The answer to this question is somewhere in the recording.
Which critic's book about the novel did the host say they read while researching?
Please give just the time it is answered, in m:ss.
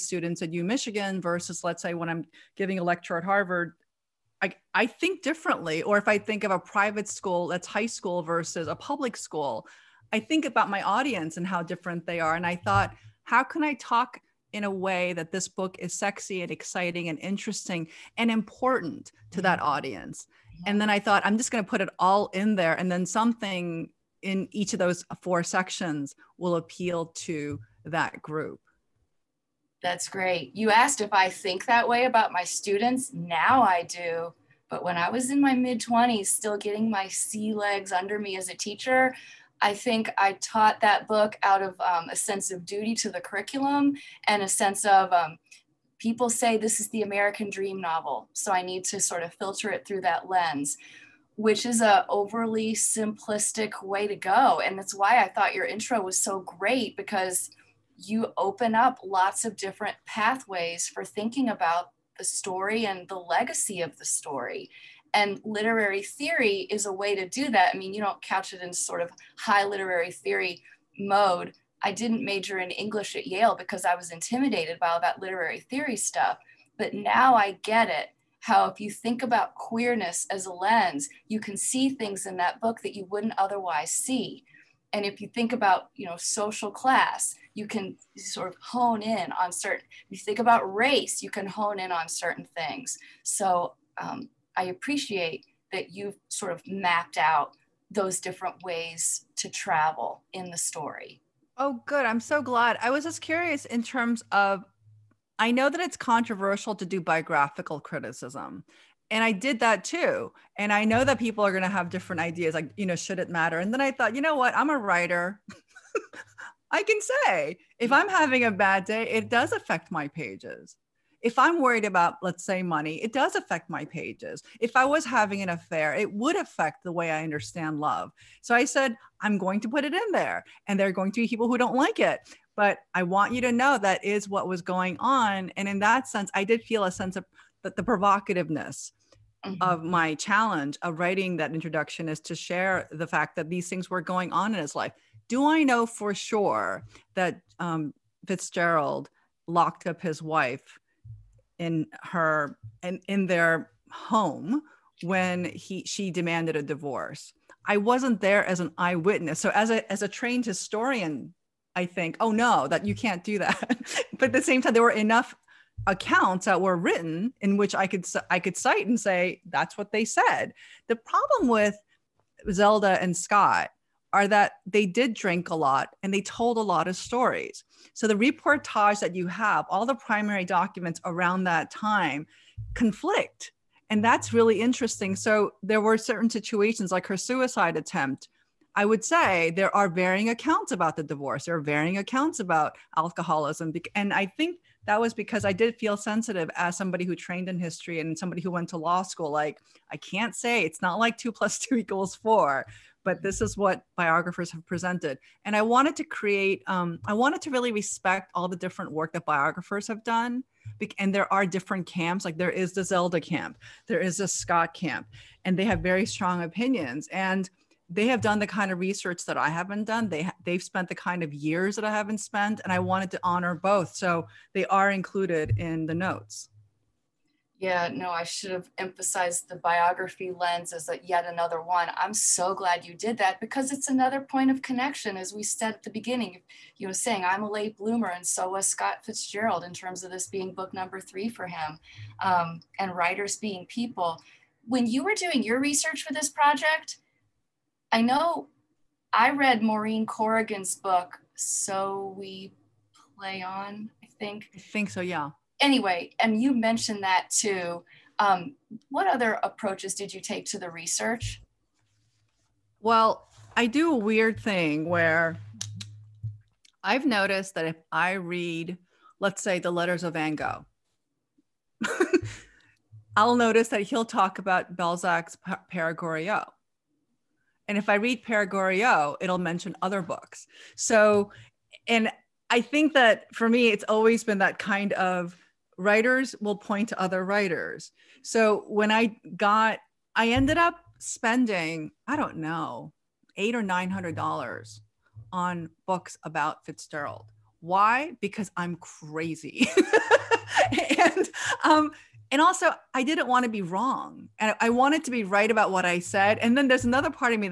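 4:09.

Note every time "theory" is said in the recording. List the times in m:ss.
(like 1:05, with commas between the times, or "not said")
1:06, 1:10, 1:15.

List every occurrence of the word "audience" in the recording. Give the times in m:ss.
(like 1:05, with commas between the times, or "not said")
0:10, 0:19.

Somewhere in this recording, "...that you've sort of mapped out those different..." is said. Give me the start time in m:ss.
1:35.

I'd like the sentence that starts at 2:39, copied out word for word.
So as a as a trained historian, I think, oh no, that you can't do that.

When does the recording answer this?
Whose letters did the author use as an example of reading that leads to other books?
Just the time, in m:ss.
4:30.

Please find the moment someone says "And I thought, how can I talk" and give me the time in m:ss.
0:12.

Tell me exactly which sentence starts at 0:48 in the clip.
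So I need to sort of filter it through that lens, which is a overly simplistic way to go.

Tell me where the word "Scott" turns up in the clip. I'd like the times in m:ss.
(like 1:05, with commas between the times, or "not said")
2:53, 3:34, 3:58.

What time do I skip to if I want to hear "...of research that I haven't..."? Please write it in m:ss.
3:38.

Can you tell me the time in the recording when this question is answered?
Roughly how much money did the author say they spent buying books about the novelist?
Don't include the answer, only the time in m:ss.
4:53.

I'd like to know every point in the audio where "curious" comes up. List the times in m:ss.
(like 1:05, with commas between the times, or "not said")
1:43.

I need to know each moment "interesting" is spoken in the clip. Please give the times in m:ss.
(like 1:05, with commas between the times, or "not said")
0:17, 3:04.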